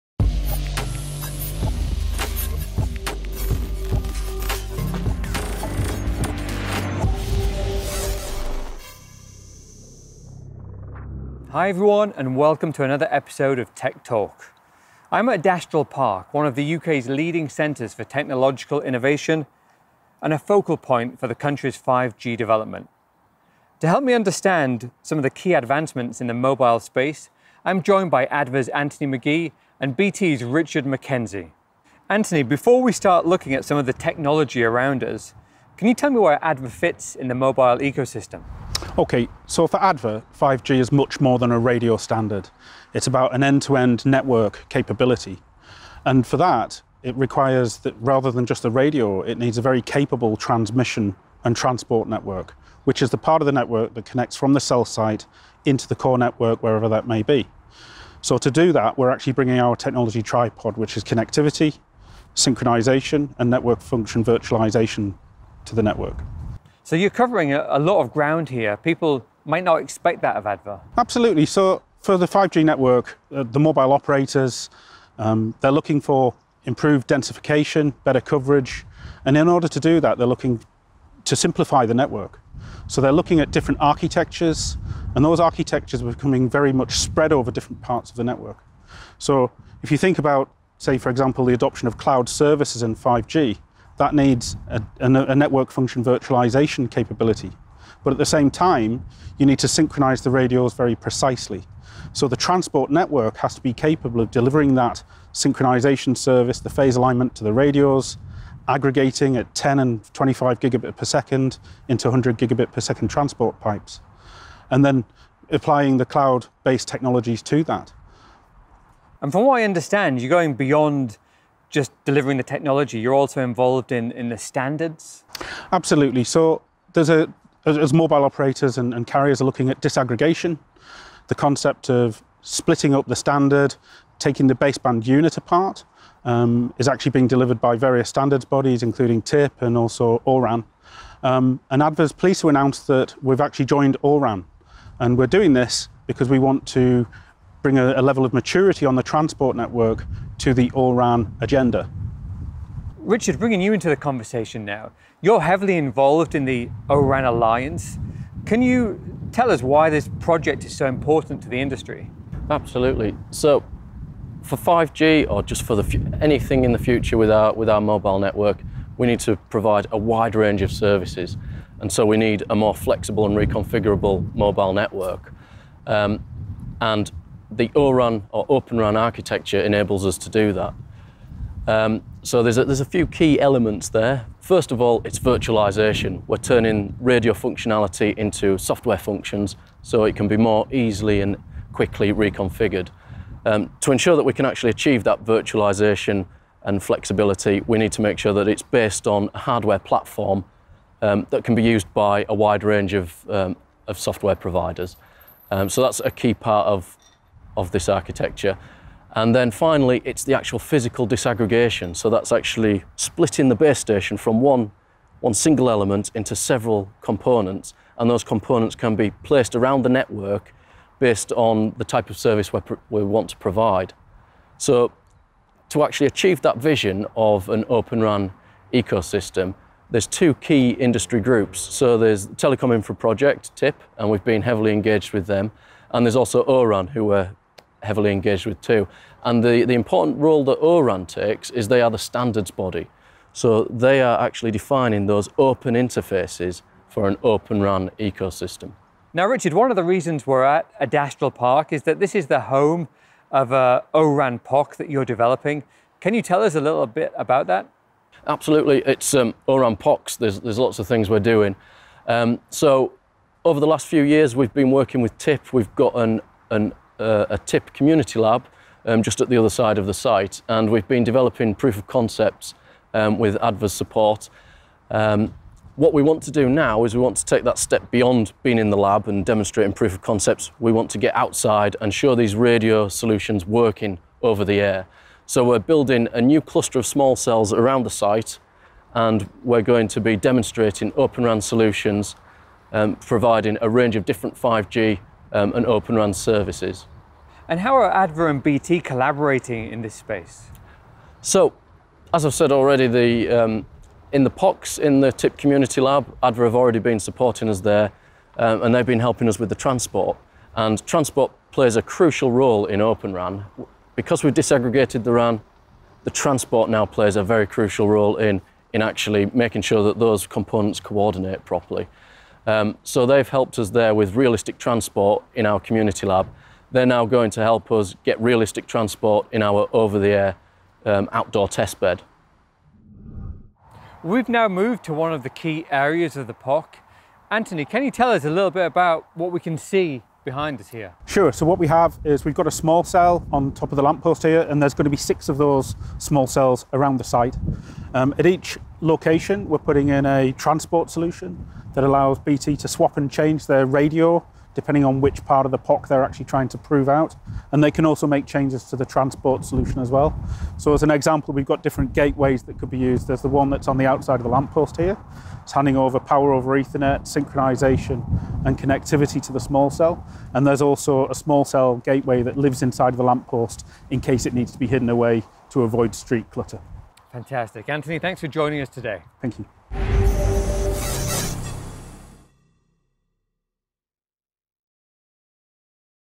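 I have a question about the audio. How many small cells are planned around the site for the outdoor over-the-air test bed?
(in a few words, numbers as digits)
6.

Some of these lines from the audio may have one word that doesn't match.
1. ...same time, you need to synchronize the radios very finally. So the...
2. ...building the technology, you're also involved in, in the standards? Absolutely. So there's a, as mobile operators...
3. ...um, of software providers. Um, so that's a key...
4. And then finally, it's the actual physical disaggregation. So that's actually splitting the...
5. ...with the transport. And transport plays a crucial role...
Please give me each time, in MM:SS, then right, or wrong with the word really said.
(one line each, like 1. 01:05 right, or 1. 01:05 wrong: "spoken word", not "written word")
1. 01:38 wrong: "precisely", not "finally"
2. 02:02 wrong: "delivering", not "building"
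3. 03:23 right
4. 03:29 right
5. 05:09 right.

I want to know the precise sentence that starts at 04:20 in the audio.
There's, there's lots of things we're doing.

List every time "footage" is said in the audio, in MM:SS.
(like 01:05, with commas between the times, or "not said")
not said.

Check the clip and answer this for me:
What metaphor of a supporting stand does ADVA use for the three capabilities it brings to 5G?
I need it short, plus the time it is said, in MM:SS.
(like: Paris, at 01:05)
technology tripod, at 00:59.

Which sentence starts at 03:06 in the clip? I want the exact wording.
We're turning radio functionality into software functions so it can be more easily and quickly reconfigured.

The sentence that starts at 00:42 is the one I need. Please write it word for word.
It's about an end-to-end -end network capability.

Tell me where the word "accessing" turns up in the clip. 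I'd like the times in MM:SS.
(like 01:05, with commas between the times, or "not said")
not said.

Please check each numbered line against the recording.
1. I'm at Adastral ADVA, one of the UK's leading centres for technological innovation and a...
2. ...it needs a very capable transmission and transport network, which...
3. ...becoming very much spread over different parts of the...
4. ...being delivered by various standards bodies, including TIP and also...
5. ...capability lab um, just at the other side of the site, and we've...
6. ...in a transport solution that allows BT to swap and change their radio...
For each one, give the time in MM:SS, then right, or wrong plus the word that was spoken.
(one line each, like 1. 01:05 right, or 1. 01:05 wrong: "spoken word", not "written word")
1. 00:15 wrong: "Park", not "ADVA"
2. 00:49 right
3. 01:26 right
4. 02:17 right
5. 04:27 wrong: "community", not "capability"
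6. 05:49 right.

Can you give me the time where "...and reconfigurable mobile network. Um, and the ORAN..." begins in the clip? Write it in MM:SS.
02:53.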